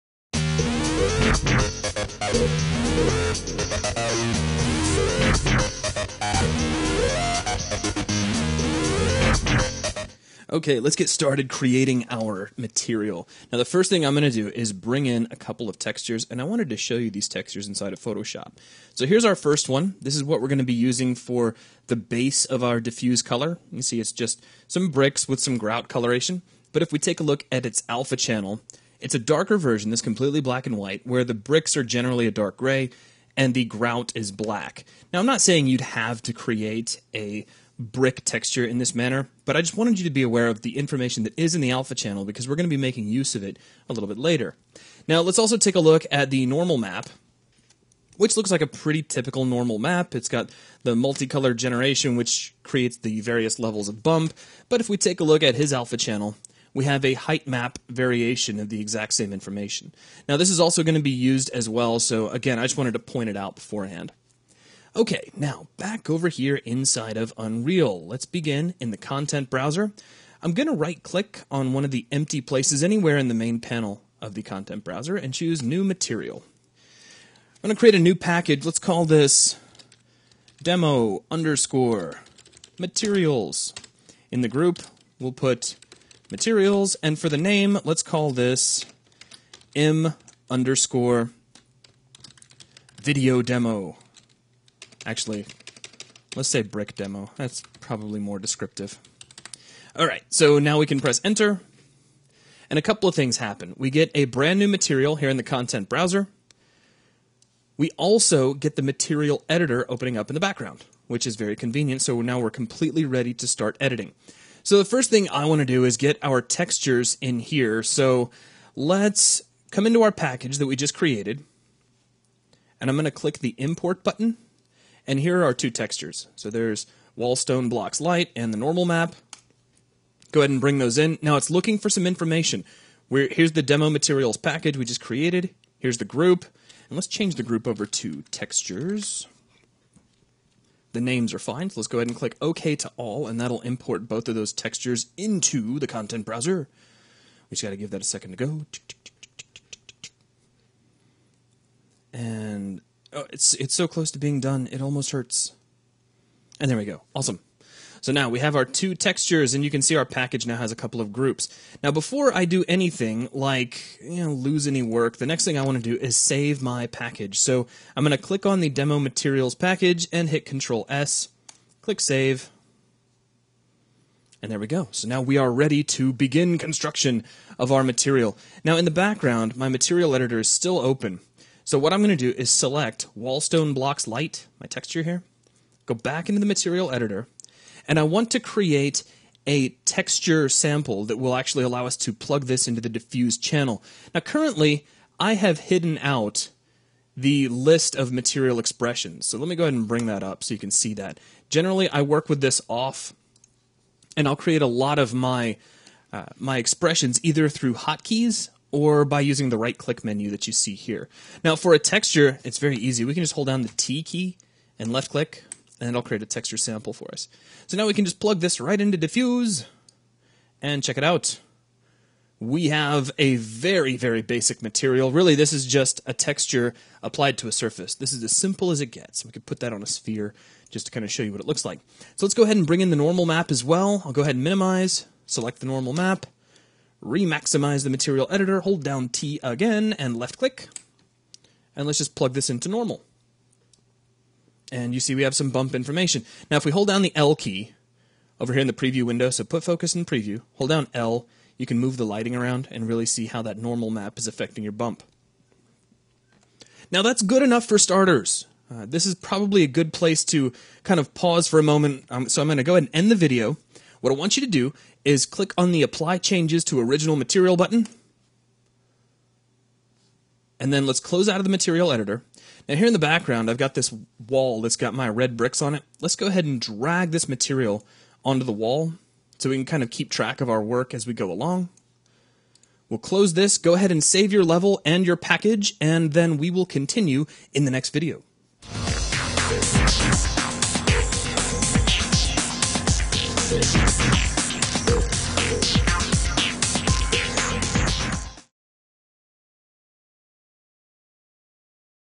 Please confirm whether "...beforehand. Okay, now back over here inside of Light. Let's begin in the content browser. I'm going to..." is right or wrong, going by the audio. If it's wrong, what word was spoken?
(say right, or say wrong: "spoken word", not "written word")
wrong: "Unreal", not "Light".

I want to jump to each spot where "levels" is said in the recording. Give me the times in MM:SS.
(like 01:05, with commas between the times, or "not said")
00:53, 04:44.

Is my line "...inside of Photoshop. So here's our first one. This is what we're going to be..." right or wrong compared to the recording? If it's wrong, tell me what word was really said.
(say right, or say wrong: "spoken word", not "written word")
right.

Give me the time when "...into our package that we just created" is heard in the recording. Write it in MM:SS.
01:59.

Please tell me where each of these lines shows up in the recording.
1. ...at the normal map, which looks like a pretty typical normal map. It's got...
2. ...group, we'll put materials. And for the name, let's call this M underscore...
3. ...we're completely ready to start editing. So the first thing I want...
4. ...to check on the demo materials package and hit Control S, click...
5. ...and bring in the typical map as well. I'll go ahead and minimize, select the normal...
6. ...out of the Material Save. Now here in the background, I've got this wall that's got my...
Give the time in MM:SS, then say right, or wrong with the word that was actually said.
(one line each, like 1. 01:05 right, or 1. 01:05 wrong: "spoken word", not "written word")
1. 00:46 right
2. 01:24 right
3. 01:52 right
4. 02:48 wrong: "click", not "check"
5. 03:52 wrong: "normal", not "typical"
6. 04:31 wrong: "Editor", not "Save".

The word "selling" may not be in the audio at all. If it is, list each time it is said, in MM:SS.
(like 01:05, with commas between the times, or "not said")
not said.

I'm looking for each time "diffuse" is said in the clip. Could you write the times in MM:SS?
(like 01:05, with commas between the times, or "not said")
00:22, 03:12, 03:38.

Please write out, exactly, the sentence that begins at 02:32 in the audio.
And oh, it's it's so close to being done, it almost hurts.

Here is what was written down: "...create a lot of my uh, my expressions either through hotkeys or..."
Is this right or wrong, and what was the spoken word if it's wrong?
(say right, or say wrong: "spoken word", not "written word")
right.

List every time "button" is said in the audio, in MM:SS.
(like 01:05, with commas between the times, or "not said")
02:04, 04:27.